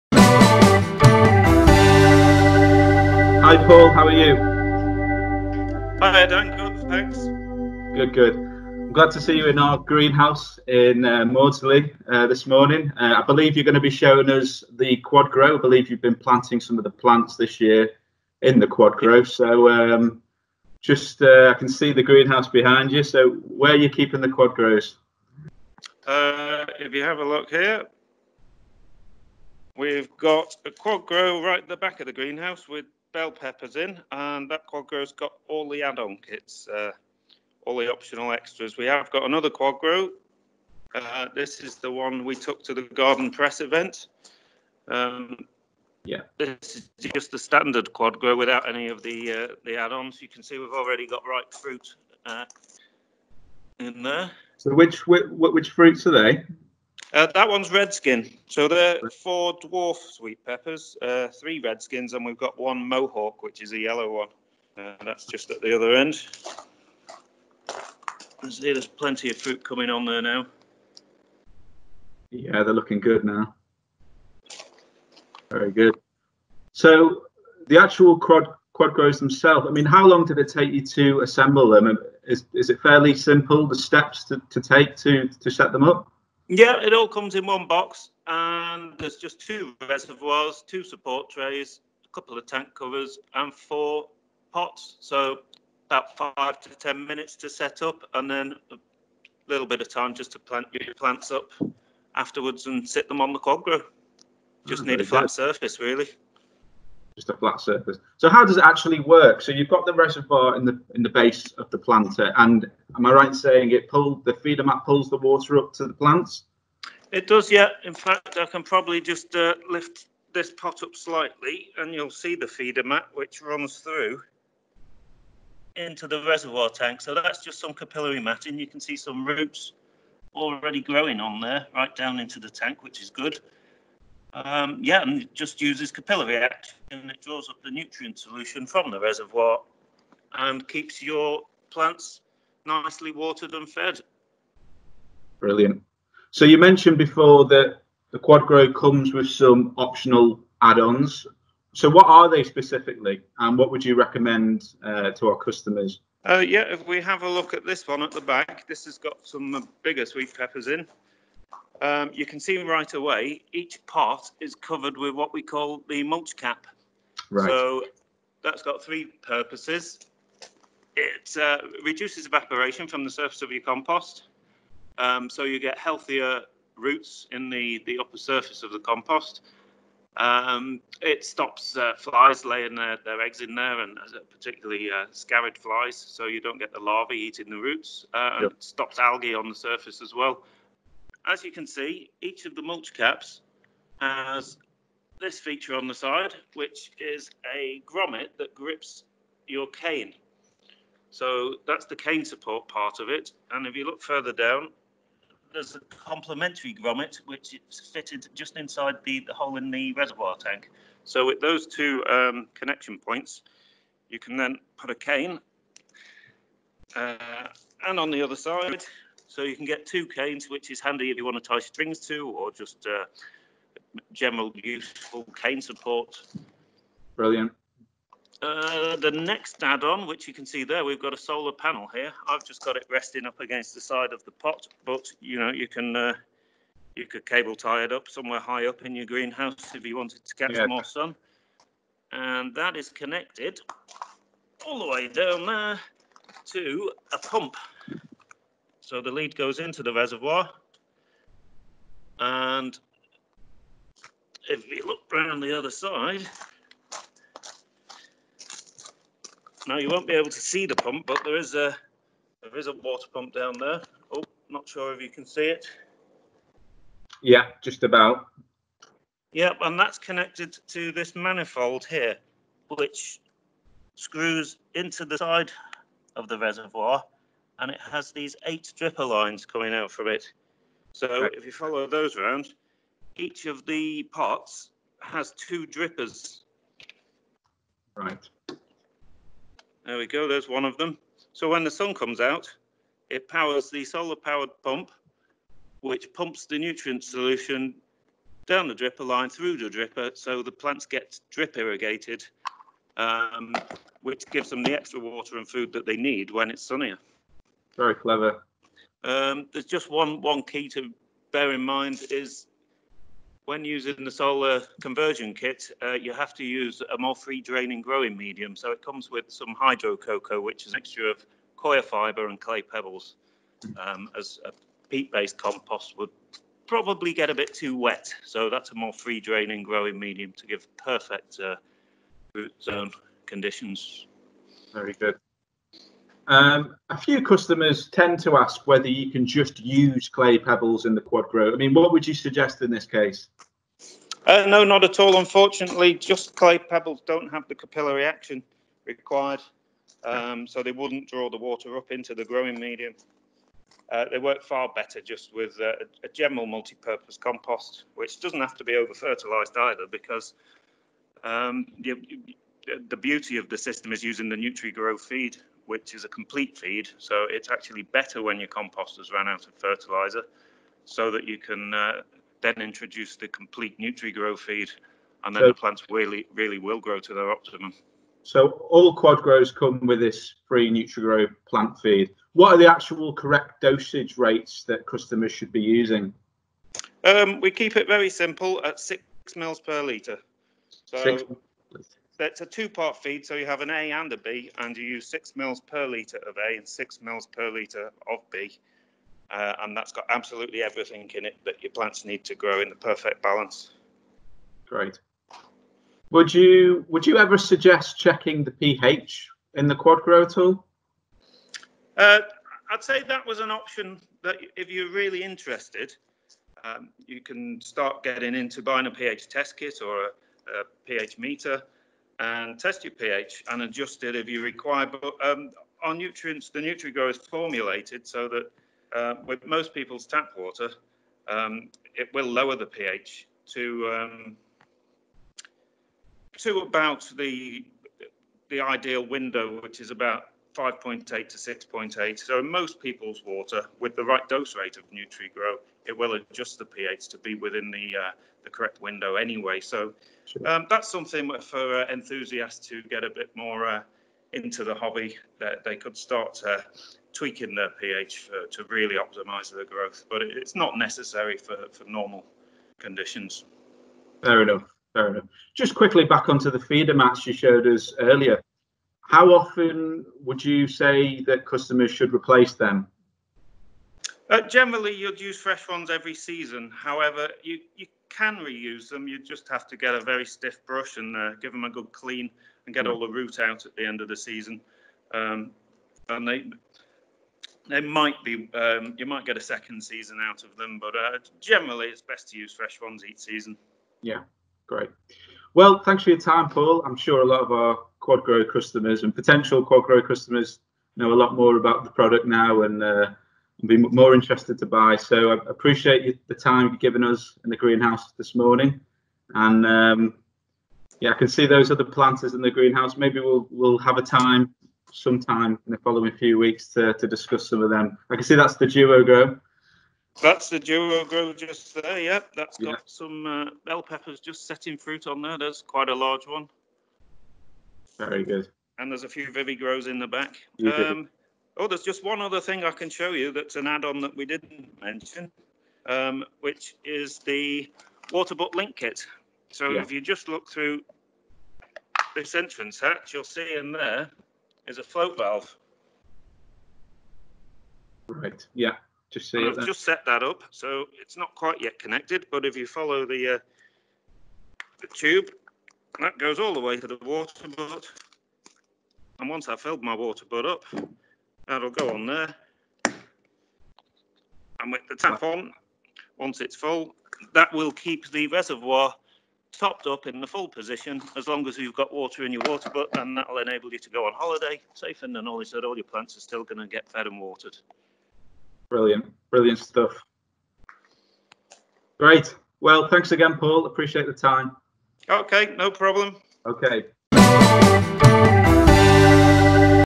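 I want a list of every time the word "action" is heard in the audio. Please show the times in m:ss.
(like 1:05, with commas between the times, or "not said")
2:16, 5:48.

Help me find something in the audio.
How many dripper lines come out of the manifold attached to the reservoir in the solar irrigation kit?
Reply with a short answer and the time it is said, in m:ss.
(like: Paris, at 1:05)
8, at 4:38.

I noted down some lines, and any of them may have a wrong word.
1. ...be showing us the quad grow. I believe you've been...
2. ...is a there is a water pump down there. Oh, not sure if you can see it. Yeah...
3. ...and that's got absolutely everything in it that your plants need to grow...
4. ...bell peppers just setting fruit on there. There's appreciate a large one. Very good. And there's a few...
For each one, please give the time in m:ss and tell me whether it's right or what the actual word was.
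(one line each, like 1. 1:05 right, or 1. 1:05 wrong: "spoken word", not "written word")
1. 0:13 right
2. 4:21 right
3. 6:39 right
4. 8:43 wrong: "quite", not "appreciate".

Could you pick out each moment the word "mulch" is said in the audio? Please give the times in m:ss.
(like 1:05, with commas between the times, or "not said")
2:46, 3:12.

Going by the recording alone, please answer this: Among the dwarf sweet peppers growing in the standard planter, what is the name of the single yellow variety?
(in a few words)
Mohawk.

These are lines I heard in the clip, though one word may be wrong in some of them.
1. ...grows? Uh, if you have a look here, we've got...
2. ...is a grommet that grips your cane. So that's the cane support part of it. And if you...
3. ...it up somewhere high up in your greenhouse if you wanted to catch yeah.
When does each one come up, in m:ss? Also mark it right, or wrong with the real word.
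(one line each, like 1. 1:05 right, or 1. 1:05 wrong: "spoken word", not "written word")
1. 0:24 right
2. 3:16 right
3. 3:57 right.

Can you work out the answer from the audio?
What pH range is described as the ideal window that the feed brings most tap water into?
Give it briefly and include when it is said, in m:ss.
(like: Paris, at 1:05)
5.8 to 6.8, at 7:20.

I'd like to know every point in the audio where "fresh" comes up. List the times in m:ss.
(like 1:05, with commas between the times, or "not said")
7:55, 8:12.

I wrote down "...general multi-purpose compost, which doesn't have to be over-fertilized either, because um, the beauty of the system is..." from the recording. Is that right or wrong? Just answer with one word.
right.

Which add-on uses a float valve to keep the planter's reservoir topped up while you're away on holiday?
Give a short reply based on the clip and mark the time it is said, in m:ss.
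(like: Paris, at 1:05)
Waterbutt link kit, at 8:58.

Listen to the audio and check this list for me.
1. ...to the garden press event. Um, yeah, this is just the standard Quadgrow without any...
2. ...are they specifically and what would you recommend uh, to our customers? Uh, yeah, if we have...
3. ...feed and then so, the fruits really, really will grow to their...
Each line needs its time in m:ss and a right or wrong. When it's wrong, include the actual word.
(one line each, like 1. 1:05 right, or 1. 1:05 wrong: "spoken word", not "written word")
1. 0:42 right
2. 2:32 right
3. 6:14 wrong: "plants", not "fruits".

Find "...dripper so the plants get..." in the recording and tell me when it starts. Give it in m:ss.
4:59.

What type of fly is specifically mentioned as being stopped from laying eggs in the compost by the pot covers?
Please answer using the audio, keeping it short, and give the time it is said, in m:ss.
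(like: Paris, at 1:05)
Sciarid flies, at 3:05.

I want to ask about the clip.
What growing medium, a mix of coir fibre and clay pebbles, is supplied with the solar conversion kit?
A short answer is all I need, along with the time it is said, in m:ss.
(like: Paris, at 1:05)
Hydro coco, at 5:19.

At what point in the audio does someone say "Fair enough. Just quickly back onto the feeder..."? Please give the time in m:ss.
7:44.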